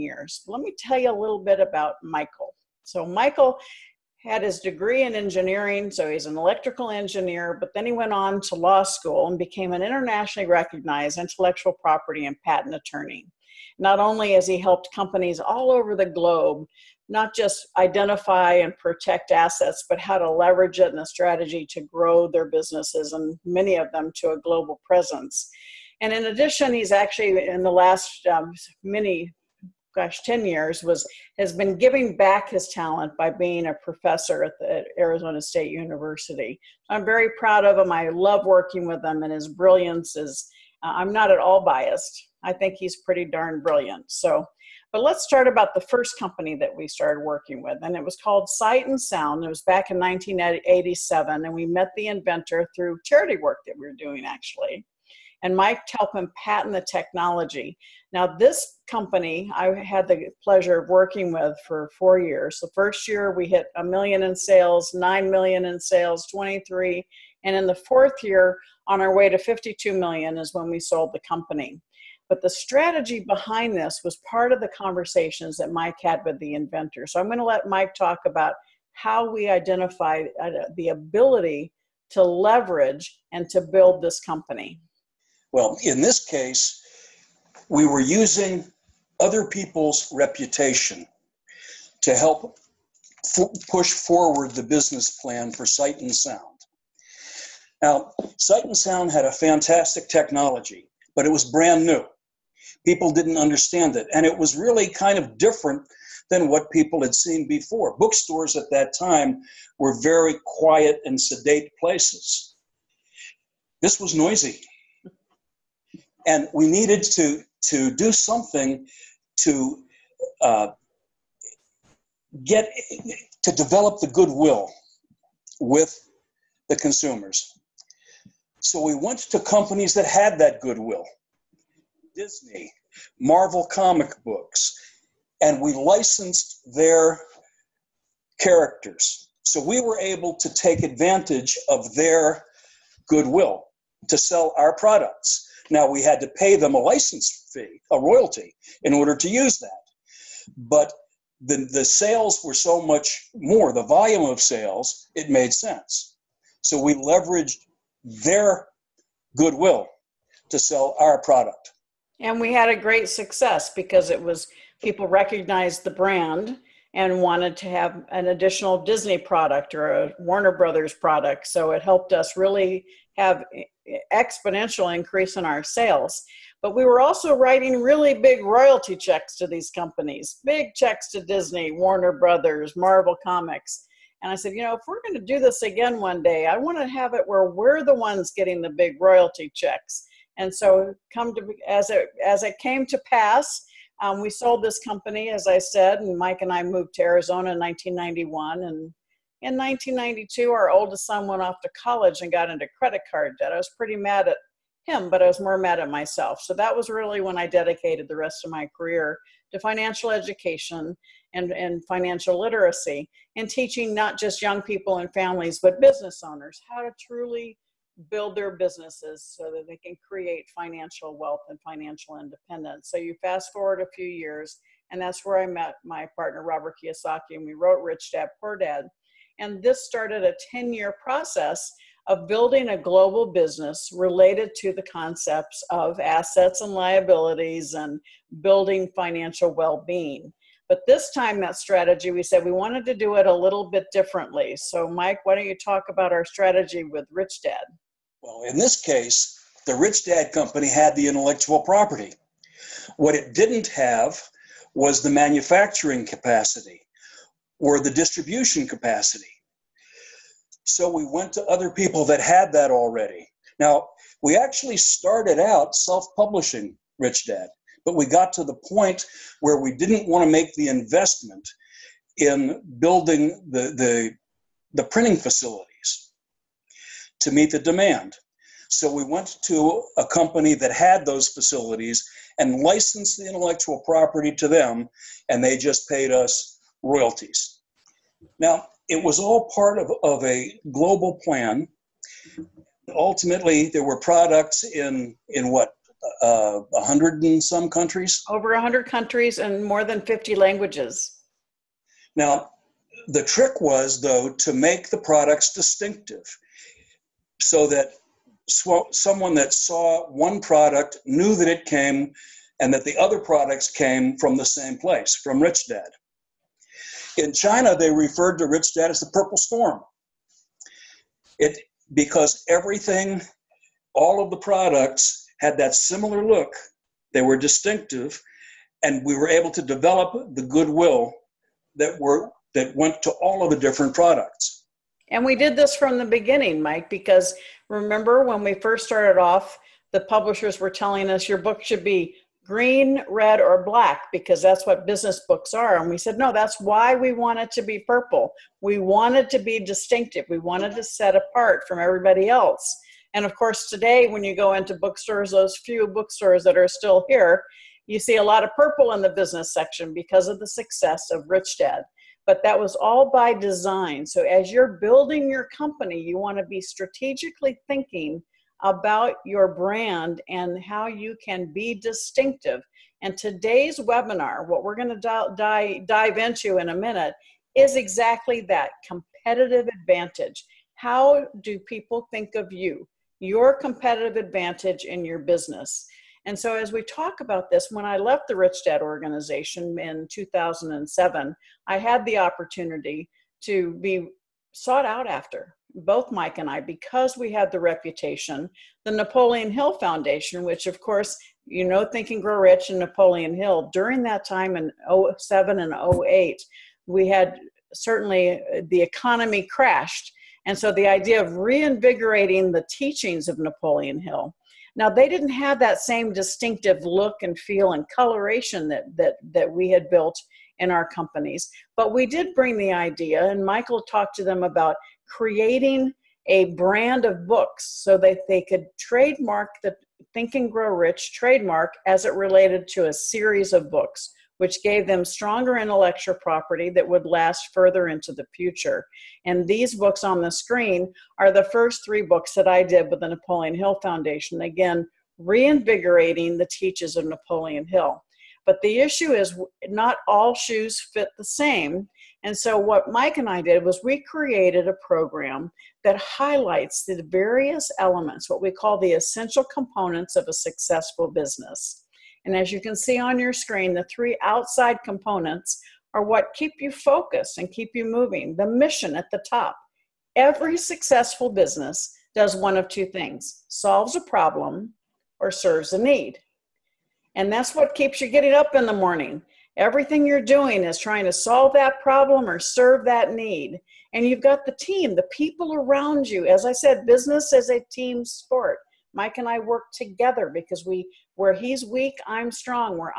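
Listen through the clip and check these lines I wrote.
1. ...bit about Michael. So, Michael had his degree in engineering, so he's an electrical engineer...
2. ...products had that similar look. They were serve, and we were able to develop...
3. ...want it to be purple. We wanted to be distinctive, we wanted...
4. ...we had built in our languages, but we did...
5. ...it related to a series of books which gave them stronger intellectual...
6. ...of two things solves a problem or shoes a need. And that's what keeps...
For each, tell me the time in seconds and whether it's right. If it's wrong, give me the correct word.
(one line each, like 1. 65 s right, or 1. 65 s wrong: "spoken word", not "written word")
1. 1 s right
2. 324 s wrong: "distinctive", not "serve"
3. 347 s right
4. 419 s wrong: "companies", not "languages"
5. 432 s right
6. 472 s wrong: "serves", not "shoes".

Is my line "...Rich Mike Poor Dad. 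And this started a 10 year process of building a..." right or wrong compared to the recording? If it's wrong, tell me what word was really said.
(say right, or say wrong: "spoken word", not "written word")
wrong: "Dad", not "Mike".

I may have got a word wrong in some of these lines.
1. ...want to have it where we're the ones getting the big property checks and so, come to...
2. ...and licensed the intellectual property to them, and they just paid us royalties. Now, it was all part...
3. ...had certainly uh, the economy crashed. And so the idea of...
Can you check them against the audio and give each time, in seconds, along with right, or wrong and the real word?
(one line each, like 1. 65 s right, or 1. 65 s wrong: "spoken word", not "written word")
1. 186 s wrong: "royalty", not "property"
2. 282 s right
3. 407 s right.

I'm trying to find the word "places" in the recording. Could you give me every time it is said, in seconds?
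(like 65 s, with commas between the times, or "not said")
111 s, 314 s.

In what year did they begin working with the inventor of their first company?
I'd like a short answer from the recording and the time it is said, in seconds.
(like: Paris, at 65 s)
1987, at 49 s.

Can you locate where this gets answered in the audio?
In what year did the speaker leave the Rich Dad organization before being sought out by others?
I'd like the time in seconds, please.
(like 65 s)
390 s.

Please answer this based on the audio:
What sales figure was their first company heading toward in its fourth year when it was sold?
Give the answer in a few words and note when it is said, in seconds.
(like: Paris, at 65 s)
52 million, at 69 s.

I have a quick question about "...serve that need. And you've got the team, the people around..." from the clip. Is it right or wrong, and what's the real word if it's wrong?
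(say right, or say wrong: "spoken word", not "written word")
right.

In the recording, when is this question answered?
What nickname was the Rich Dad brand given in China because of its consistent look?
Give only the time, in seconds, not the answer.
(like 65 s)
318 s.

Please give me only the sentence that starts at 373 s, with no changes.
And today's webinar, what we're going to dive into in a minute, is exactly that competitive advantage.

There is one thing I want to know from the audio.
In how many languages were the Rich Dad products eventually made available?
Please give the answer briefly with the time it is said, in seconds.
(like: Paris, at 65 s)
more than 50, at 299 s.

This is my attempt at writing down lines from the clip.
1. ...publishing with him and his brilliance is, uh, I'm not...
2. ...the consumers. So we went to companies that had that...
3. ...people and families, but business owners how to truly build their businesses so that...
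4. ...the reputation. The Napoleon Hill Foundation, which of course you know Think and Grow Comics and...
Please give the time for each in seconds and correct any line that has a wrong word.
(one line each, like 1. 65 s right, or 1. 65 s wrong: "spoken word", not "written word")
1. 38 s wrong: "working", not "publishing"
2. 126 s right
3. 214 s right
4. 397 s wrong: "Rich", not "Comics".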